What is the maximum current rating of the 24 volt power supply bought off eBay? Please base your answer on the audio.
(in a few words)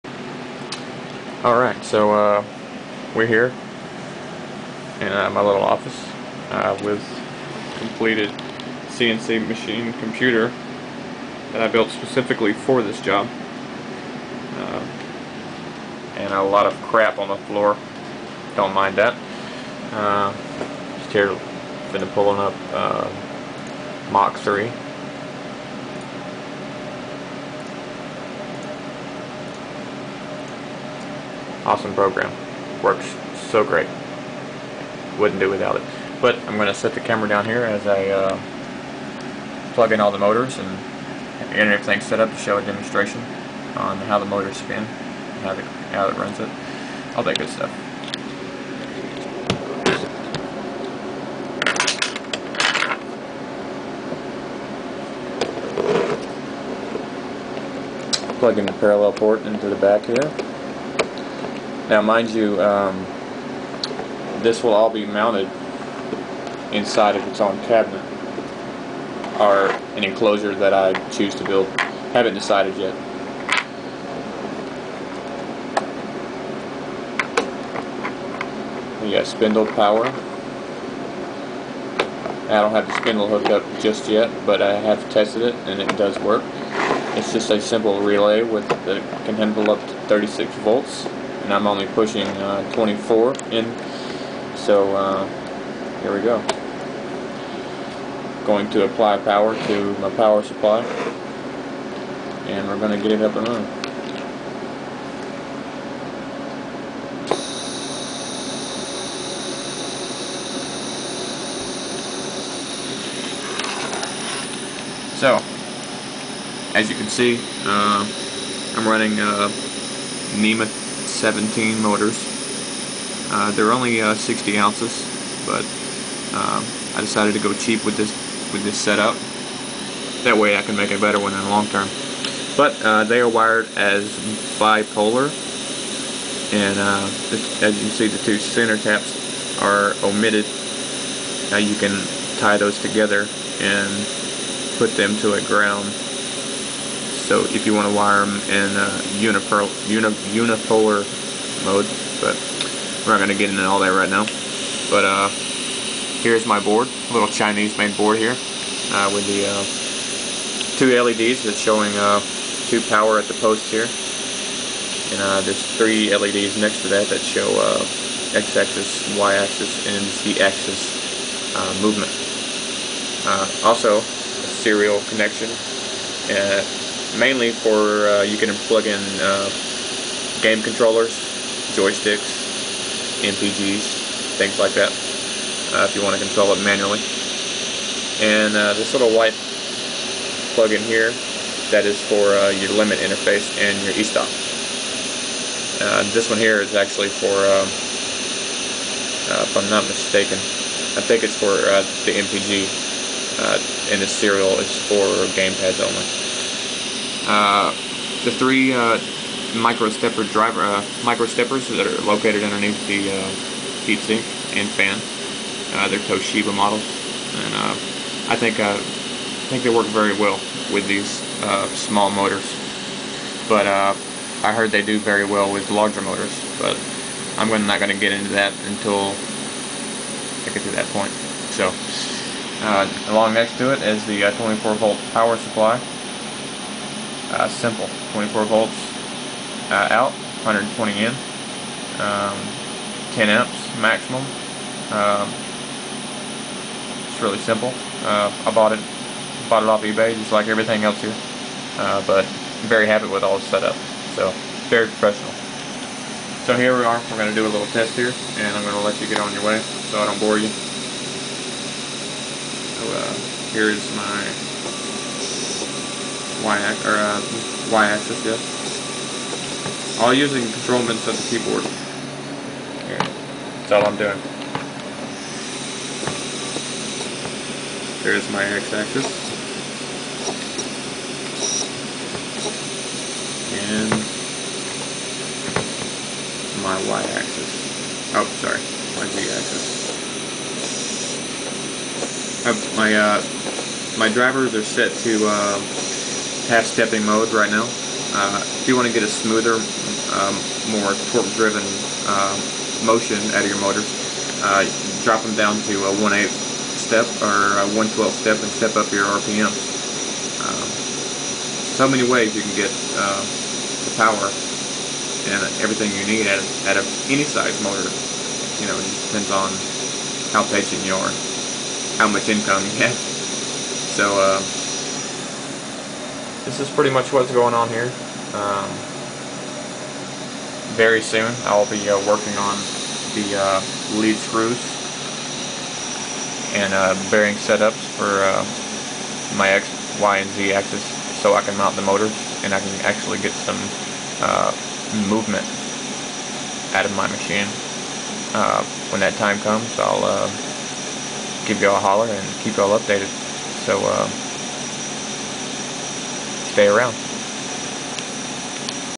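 10 amps.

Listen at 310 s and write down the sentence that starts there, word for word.
Um, so many ways you can get um, the power and everything you need out of, out of any size motor.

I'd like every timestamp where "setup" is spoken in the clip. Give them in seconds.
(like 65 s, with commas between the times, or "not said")
128 s, 253 s, 337 s.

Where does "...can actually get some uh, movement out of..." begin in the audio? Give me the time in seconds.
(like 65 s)
342 s.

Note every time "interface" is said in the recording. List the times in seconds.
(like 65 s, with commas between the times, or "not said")
192 s.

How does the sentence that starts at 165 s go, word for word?
And there's three LEDs next to that that show x-axis, y-axis, and z-axis movement.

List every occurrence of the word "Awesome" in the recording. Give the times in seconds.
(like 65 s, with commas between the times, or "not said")
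31 s.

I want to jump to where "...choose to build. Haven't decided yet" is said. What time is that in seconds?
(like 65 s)
71 s.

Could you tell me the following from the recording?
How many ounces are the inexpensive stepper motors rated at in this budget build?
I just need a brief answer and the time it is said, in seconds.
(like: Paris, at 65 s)
60 ounces, at 124 s.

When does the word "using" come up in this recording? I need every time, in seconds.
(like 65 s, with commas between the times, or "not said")
270 s.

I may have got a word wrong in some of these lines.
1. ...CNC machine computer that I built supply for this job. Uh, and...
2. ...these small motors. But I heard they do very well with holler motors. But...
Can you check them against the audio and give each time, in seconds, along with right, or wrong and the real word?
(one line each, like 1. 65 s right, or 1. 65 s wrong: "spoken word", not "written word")
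1. 8 s wrong: "specifically", not "supply"
2. 220 s wrong: "larger", not "holler".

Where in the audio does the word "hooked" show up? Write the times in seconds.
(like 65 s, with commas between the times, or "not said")
83 s.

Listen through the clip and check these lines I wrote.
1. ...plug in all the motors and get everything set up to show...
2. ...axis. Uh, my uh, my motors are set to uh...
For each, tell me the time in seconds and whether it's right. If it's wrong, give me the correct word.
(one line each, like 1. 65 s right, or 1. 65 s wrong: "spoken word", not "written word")
1. 39 s right
2. 289 s wrong: "drivers", not "motors".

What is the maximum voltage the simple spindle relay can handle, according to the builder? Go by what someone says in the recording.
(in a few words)
36 volts.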